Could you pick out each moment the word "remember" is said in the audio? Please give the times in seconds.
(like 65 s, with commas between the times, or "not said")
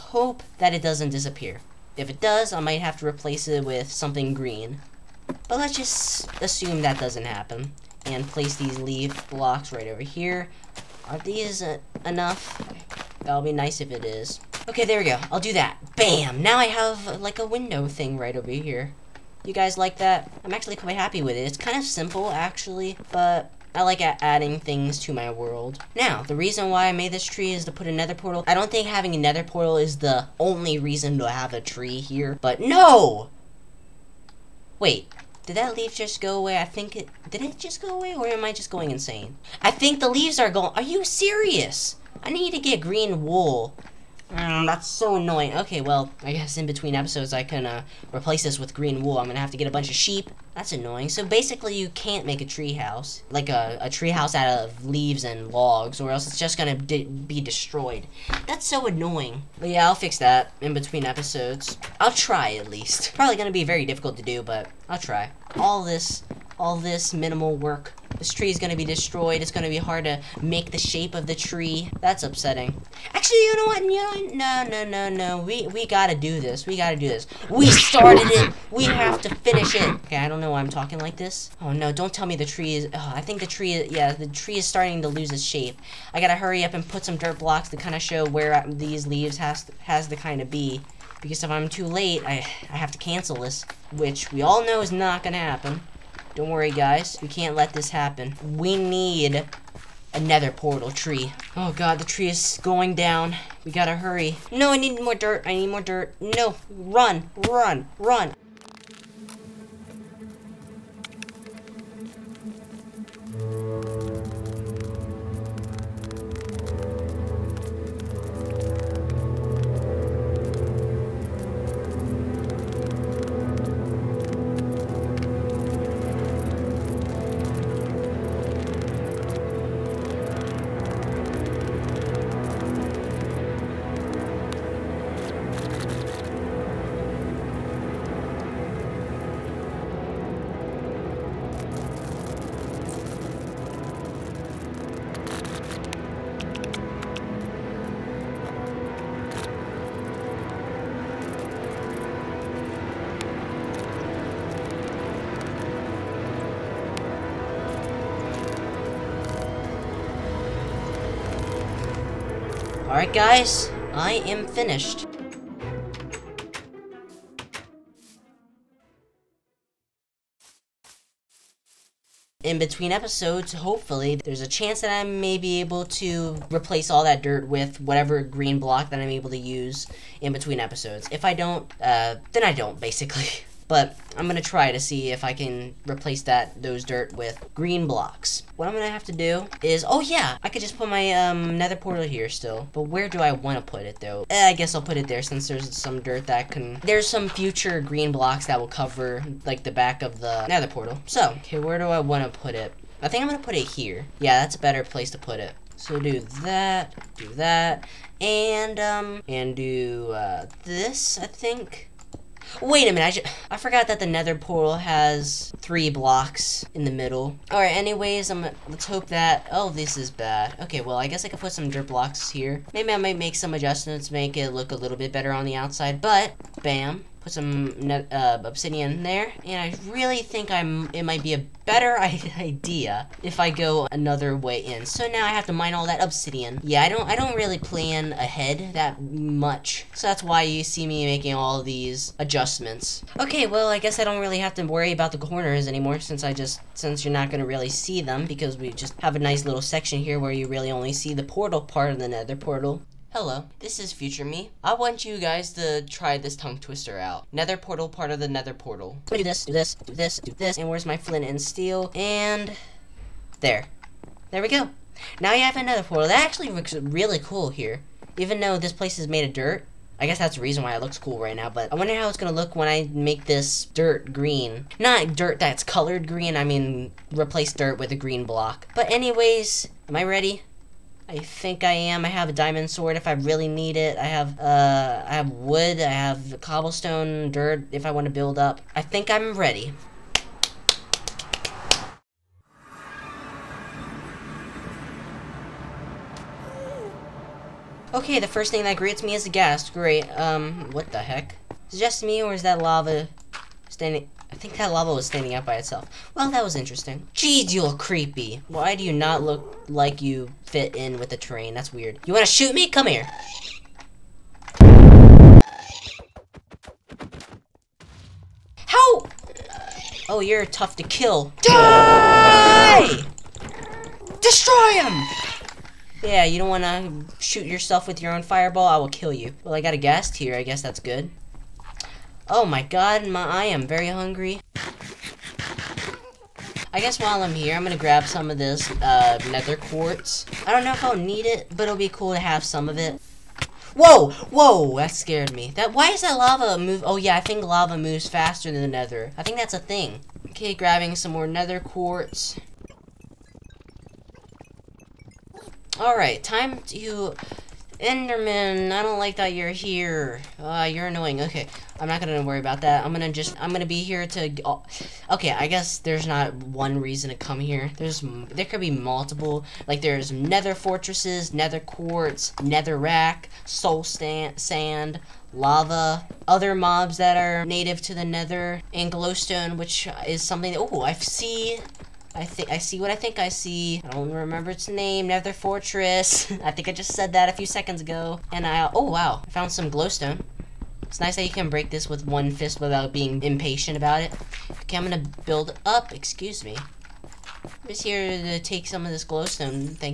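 384 s.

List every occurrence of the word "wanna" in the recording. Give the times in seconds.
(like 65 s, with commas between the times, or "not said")
193 s, 201 s, 312 s, 326 s.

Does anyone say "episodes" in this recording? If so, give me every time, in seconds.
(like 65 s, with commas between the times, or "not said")
46 s, 61 s, 172 s, 180 s.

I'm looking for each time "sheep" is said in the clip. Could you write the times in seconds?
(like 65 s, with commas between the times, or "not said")
49 s.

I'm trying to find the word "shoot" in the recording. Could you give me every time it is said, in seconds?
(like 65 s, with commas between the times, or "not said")
312 s, 327 s.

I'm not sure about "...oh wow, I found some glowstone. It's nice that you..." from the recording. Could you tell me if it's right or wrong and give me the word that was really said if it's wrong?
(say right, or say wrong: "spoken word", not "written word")
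right.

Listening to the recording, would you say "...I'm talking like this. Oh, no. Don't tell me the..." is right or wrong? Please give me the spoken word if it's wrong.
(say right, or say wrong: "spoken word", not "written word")
right.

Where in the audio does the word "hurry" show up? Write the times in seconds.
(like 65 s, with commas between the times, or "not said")
86 s, 103 s.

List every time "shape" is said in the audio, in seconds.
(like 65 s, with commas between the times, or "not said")
70 s, 85 s.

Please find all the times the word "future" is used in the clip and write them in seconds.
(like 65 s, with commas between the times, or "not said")
197 s, 253 s.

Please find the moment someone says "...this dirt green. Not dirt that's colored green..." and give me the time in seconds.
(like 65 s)
273 s.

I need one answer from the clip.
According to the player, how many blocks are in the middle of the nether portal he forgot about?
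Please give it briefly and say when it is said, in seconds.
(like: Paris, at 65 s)
3, at 215 s.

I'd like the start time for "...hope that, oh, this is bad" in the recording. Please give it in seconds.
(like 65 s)
218 s.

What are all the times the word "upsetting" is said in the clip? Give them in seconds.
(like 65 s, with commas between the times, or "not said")
72 s.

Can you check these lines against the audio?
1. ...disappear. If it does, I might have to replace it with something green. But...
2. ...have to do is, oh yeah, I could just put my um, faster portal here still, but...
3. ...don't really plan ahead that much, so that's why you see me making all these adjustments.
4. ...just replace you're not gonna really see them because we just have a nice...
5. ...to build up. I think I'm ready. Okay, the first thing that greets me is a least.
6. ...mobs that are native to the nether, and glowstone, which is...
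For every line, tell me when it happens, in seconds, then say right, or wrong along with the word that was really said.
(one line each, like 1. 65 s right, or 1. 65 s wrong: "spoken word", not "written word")
1. 1 s right
2. 188 s wrong: "nether", not "faster"
3. 237 s right
4. 246 s wrong: "since", not "replace"
5. 288 s wrong: "ghast", not "least"
6. 376 s right.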